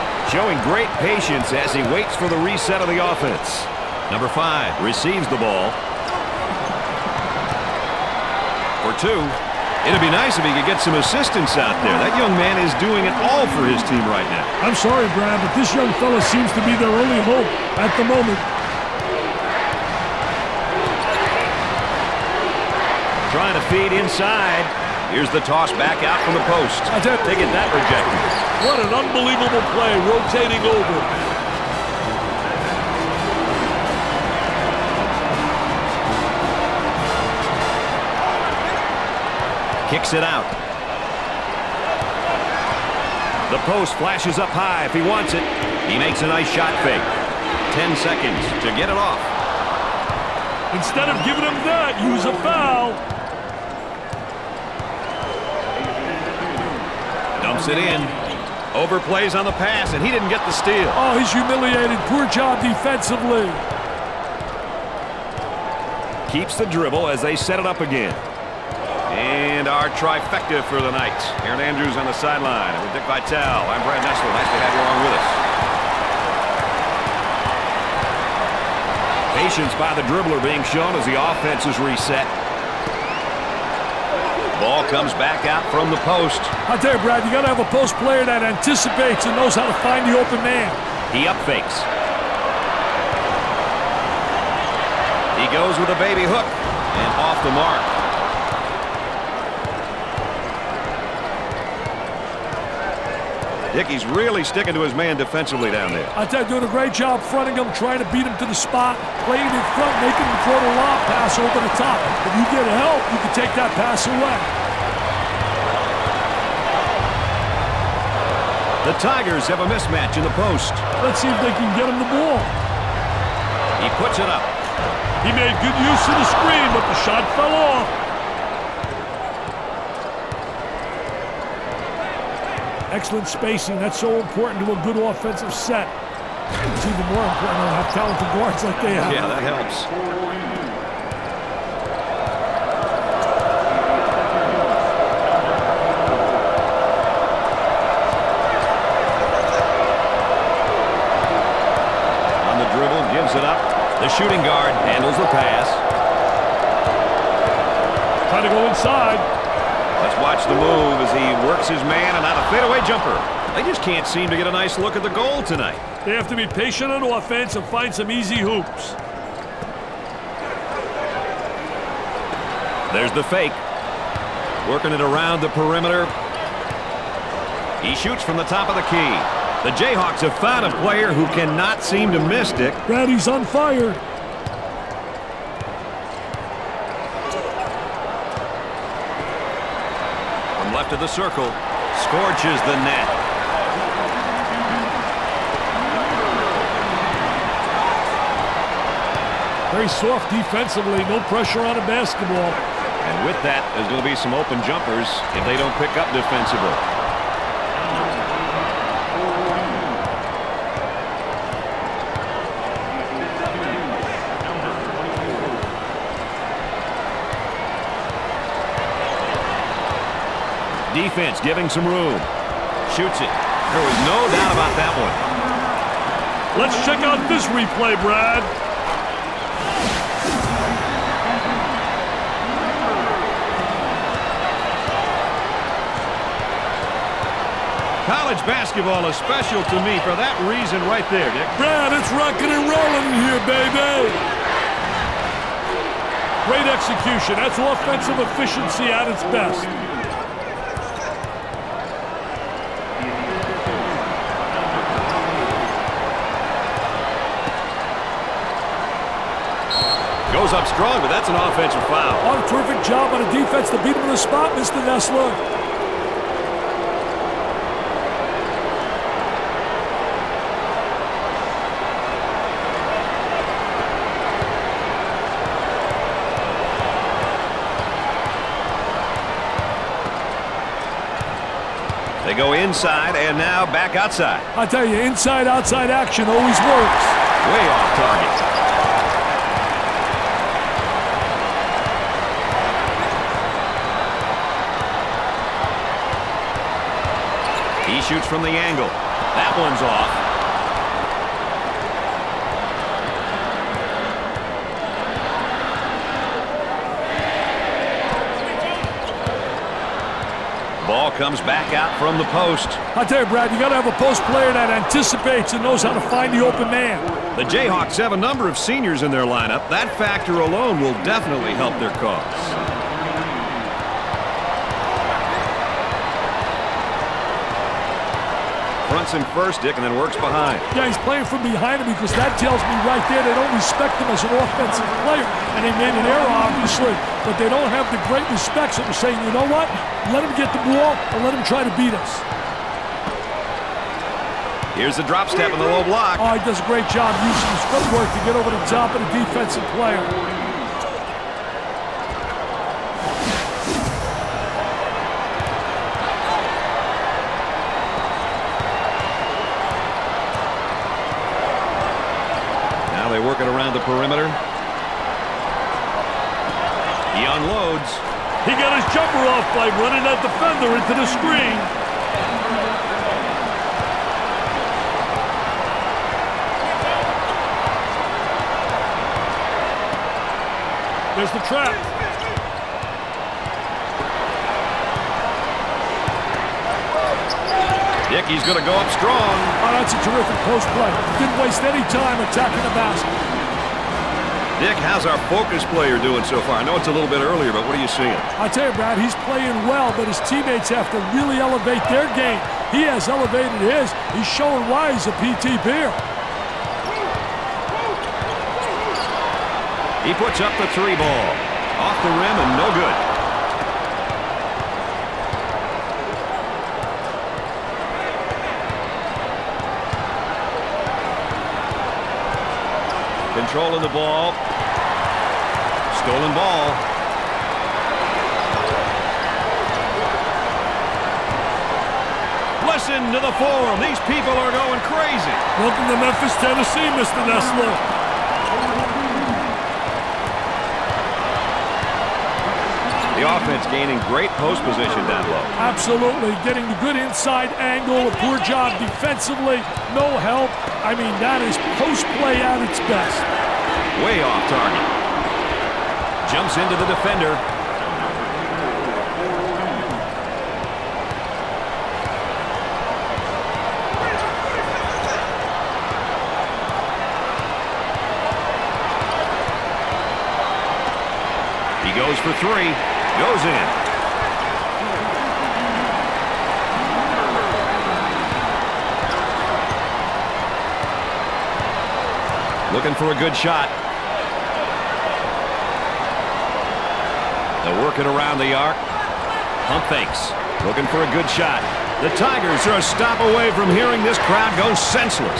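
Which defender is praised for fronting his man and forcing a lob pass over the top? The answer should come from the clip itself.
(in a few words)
Hickey.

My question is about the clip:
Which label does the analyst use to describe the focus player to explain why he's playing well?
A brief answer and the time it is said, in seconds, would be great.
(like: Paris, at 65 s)
PTPer, at 405 s.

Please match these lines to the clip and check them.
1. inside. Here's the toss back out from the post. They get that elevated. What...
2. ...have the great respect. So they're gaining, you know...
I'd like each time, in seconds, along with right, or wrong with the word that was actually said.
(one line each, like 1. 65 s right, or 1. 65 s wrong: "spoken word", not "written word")
1. 23 s wrong: "rejected", not "elevated"
2. 337 s wrong: "saying", not "gaining".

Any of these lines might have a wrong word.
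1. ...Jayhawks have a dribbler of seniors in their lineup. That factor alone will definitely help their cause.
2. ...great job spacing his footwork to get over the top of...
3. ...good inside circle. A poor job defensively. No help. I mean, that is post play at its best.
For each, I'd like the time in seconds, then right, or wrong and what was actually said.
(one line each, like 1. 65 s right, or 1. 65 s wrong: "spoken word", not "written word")
1. 317 s wrong: "number", not "dribbler"
2. 346 s wrong: "using", not "spacing"
3. 446 s wrong: "angle", not "circle".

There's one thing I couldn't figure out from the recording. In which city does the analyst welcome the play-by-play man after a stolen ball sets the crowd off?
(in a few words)
Memphis, Tennessee.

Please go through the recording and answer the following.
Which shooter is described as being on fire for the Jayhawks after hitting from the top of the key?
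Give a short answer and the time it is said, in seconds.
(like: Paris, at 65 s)
Brady, at 182 s.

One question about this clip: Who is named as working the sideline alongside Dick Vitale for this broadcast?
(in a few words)
Erin Andrews.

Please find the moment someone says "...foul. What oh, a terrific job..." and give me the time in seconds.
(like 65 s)
261 s.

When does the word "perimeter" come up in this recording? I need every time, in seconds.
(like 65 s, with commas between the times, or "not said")
175 s, 363 s.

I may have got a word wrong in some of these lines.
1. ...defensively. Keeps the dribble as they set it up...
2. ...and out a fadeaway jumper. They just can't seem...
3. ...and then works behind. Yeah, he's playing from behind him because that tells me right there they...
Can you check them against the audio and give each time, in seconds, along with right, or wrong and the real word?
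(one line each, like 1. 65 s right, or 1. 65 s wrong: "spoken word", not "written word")
1. 62 s right
2. 162 s right
3. 329 s right.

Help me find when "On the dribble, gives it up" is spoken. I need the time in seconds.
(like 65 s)
152 s.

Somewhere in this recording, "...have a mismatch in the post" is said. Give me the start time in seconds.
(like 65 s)
119 s.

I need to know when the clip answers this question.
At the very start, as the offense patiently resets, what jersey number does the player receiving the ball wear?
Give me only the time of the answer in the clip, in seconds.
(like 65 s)
4 s.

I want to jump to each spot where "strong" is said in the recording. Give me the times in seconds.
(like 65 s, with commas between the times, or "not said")
260 s, 388 s.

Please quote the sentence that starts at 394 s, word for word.
Nick, how's our focus player doing so far?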